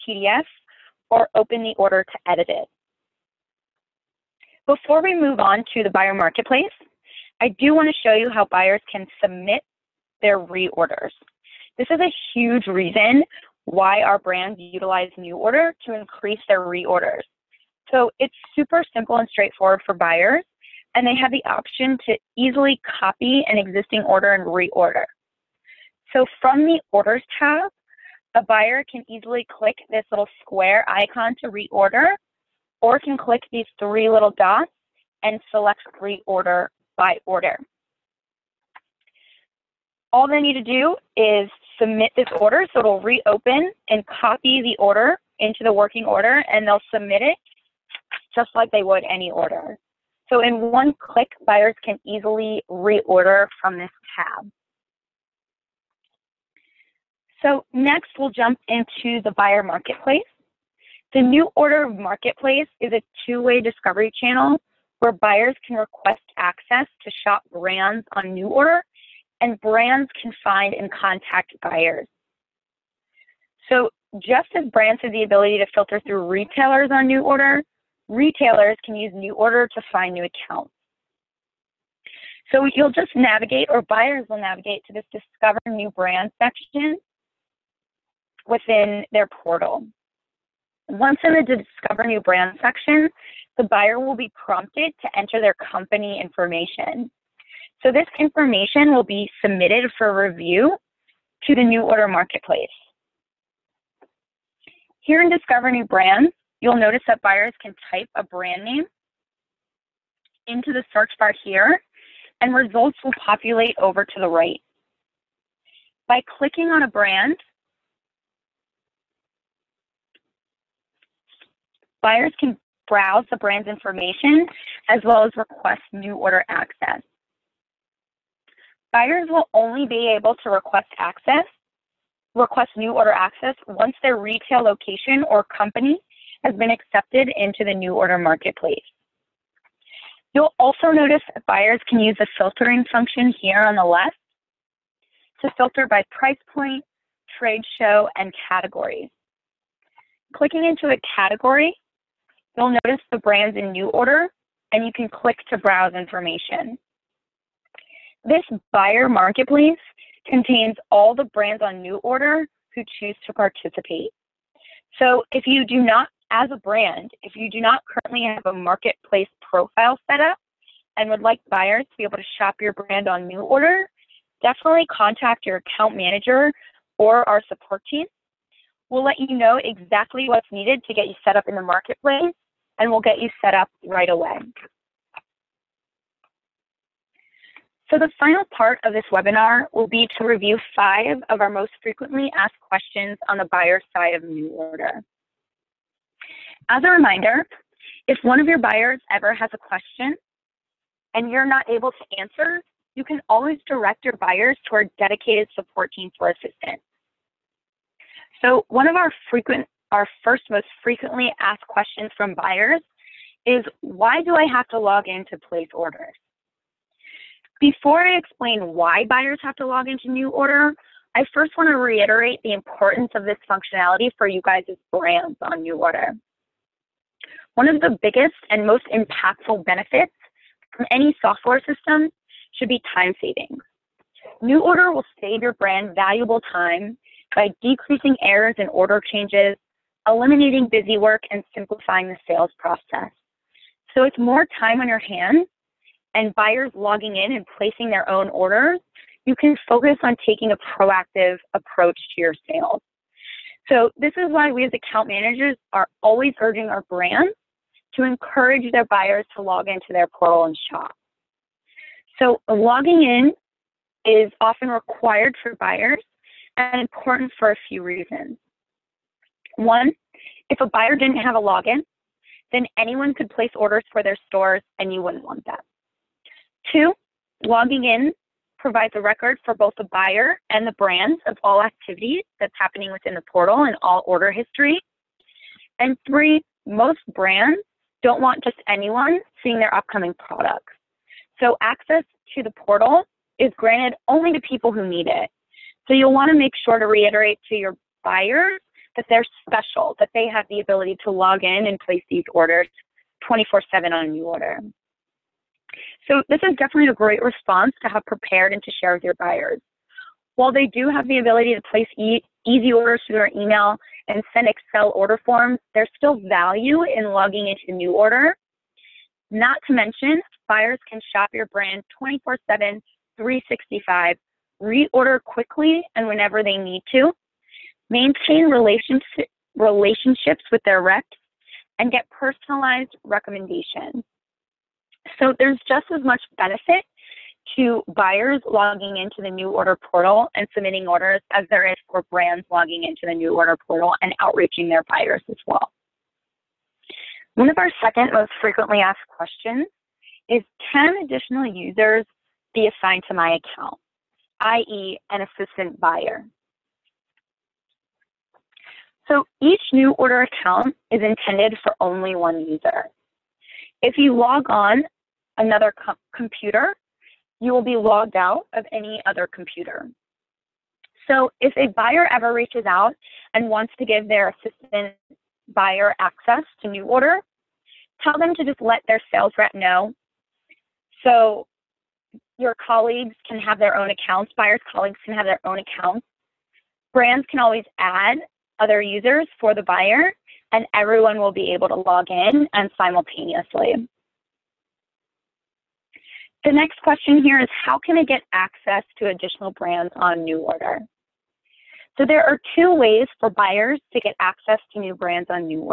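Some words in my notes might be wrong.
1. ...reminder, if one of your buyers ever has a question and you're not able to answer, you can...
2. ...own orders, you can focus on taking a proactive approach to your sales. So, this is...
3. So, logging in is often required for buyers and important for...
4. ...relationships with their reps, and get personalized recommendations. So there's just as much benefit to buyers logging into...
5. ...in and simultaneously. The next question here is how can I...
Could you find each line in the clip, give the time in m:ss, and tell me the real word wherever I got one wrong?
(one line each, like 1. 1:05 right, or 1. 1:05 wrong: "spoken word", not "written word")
1. 3:16 right
2. 4:08 right
3. 4:22 right
4. 5:29 right
5. 6:32 right.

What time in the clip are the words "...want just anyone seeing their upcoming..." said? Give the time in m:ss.
4:48.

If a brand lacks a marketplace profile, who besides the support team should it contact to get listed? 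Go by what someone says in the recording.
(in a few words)
account manager.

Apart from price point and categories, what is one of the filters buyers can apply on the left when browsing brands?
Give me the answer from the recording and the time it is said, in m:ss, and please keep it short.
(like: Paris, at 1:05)
trade show, at 2:27.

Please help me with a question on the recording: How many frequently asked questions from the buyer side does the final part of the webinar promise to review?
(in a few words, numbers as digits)
5.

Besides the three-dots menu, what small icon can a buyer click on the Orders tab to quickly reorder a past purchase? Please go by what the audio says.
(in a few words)
little square icon.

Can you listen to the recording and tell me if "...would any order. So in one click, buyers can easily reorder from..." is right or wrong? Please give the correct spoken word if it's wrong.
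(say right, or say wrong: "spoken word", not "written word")
right.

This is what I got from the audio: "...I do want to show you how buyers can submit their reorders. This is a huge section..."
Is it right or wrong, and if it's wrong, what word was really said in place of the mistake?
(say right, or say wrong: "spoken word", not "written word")
wrong: "reason", not "section".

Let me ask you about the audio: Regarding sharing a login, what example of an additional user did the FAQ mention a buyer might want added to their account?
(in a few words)
an assistant buyer.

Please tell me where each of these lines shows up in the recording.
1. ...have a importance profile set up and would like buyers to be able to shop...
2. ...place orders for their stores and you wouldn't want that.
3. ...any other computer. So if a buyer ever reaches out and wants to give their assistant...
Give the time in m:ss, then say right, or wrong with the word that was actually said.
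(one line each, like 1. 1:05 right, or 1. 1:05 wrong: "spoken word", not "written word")
1. 2:48 wrong: "marketplace", not "importance"
2. 4:33 right
3. 6:08 right.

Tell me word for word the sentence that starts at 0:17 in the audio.
So it's super simple and straightforward for buyers, and they have the option to easily copy an existing order and reorder.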